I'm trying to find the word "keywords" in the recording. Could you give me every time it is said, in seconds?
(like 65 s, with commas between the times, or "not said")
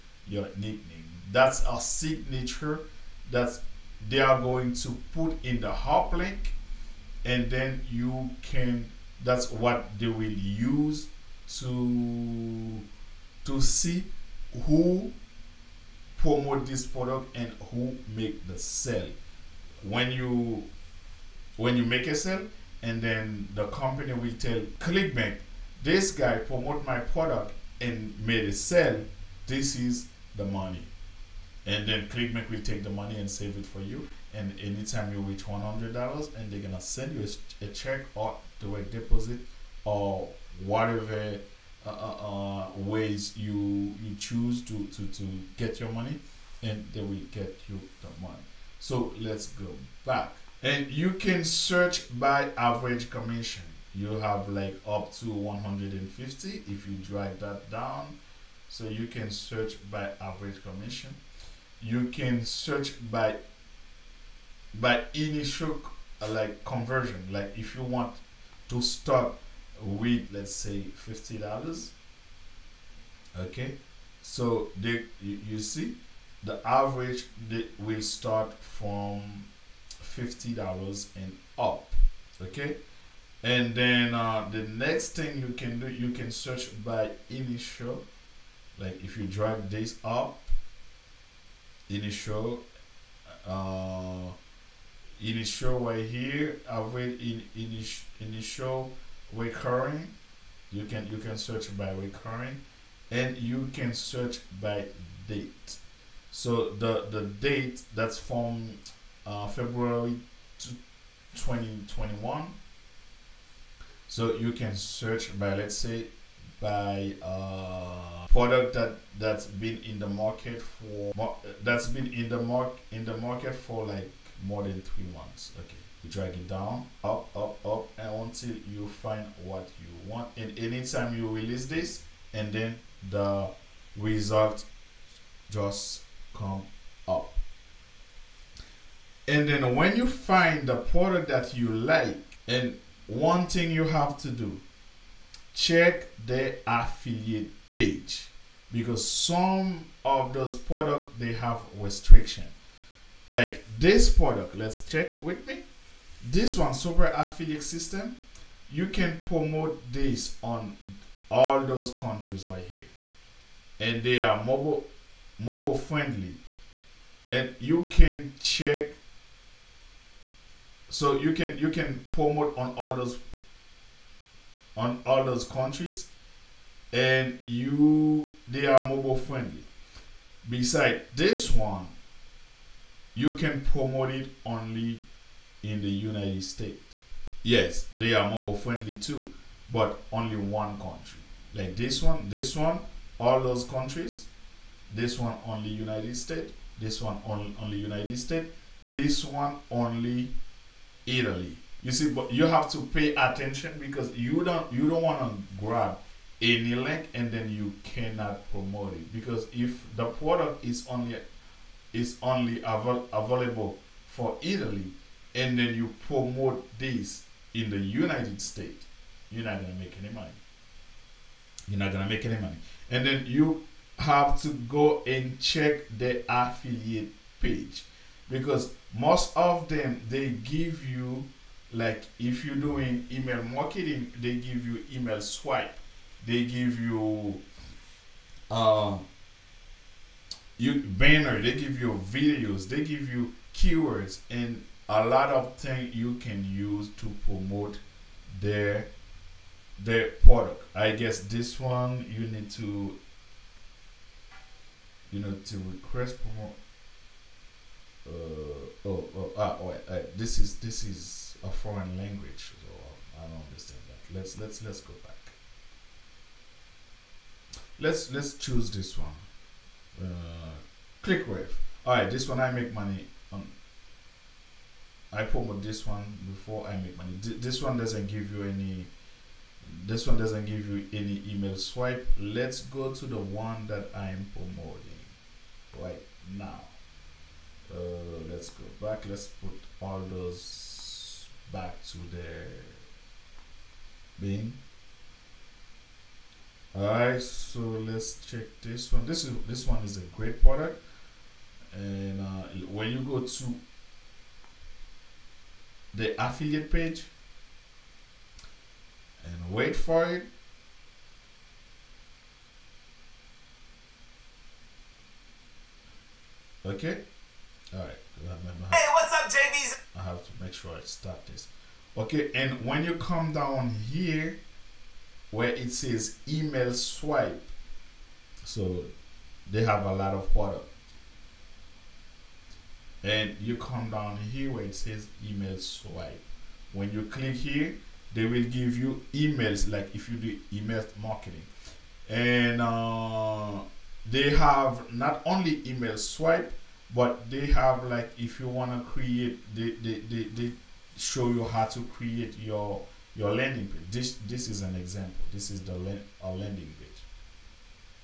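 243 s.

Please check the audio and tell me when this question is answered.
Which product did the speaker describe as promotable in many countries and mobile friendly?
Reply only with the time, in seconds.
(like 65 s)
156 s.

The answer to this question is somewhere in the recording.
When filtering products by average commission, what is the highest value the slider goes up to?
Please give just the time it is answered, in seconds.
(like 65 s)
55 s.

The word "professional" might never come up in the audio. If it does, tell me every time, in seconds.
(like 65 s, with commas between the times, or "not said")
not said.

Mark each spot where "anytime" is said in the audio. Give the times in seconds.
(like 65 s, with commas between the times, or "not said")
34 s, 130 s.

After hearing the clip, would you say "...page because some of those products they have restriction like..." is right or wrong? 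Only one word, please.
right.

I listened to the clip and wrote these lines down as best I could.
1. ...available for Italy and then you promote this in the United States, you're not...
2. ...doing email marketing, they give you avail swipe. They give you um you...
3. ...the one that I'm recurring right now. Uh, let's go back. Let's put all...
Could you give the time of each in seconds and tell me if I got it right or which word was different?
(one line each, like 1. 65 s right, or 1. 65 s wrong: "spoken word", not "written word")
1. 213 s right
2. 232 s wrong: "email", not "avail"
3. 283 s wrong: "promoting", not "recurring".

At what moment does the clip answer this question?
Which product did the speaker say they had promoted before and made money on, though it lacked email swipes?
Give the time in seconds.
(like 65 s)
271 s.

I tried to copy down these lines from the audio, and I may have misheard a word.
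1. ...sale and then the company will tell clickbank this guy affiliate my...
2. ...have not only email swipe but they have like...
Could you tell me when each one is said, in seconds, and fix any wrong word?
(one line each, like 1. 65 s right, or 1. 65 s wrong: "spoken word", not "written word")
1. 22 s wrong: "promote", not "affiliate"
2. 344 s right.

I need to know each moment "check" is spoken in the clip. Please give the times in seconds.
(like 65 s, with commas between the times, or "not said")
37 s, 145 s, 154 s, 168 s, 225 s, 298 s.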